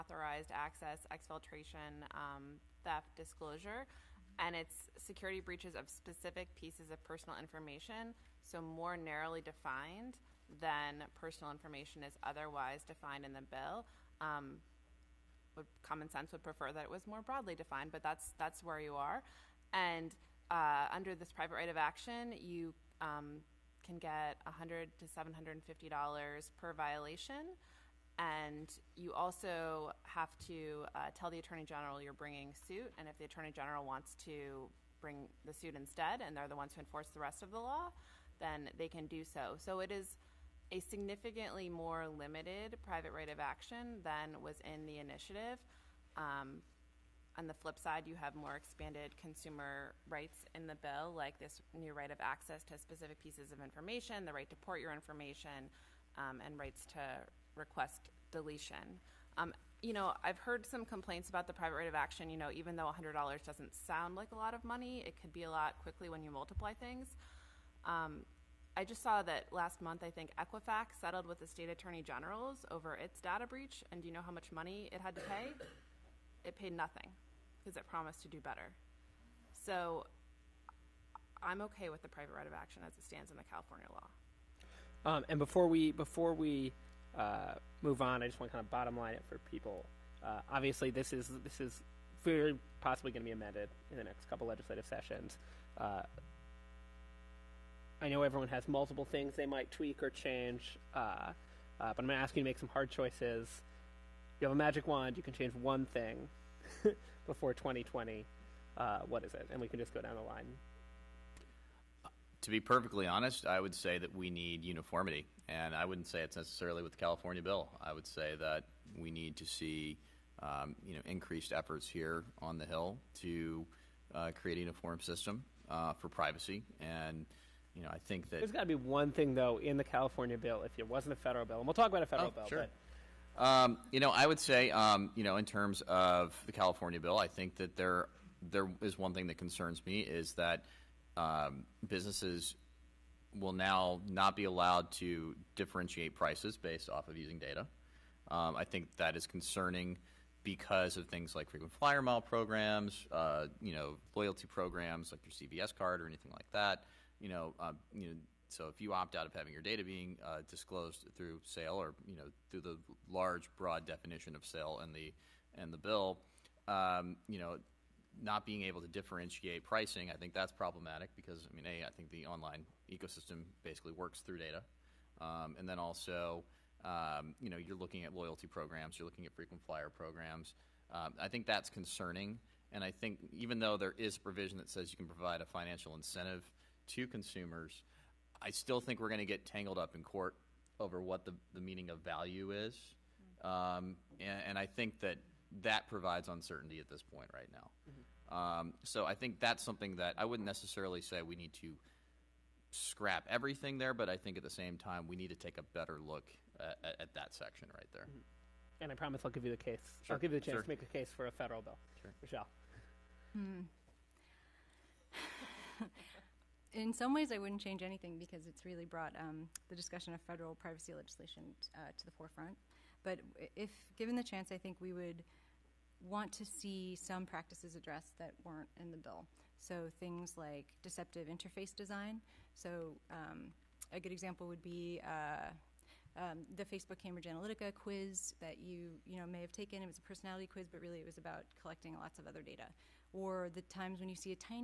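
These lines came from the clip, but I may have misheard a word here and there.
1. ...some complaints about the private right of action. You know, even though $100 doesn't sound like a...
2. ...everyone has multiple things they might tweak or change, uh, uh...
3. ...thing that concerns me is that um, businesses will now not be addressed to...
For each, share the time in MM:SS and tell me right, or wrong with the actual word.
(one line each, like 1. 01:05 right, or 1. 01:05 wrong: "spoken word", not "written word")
1. 01:00 right
2. 01:38 right
3. 02:19 wrong: "allowed", not "addressed".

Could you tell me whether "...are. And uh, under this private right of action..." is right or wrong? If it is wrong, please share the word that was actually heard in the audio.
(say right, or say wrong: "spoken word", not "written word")
right.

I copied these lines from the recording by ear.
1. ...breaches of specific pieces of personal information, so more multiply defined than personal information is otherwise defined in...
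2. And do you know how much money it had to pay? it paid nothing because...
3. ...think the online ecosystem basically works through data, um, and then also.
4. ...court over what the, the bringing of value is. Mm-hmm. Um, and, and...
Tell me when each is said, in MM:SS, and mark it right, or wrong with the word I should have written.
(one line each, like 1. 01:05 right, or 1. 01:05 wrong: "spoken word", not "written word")
1. 00:05 wrong: "narrowly", not "multiply"
2. 01:13 right
3. 02:51 right
4. 03:10 wrong: "meaning", not "bringing".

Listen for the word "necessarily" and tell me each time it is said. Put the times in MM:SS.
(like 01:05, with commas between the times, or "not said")
01:56, 03:20.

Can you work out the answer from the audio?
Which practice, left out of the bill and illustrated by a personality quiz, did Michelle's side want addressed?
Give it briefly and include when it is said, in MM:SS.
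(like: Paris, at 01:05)
deceptive interface design, at 03:50.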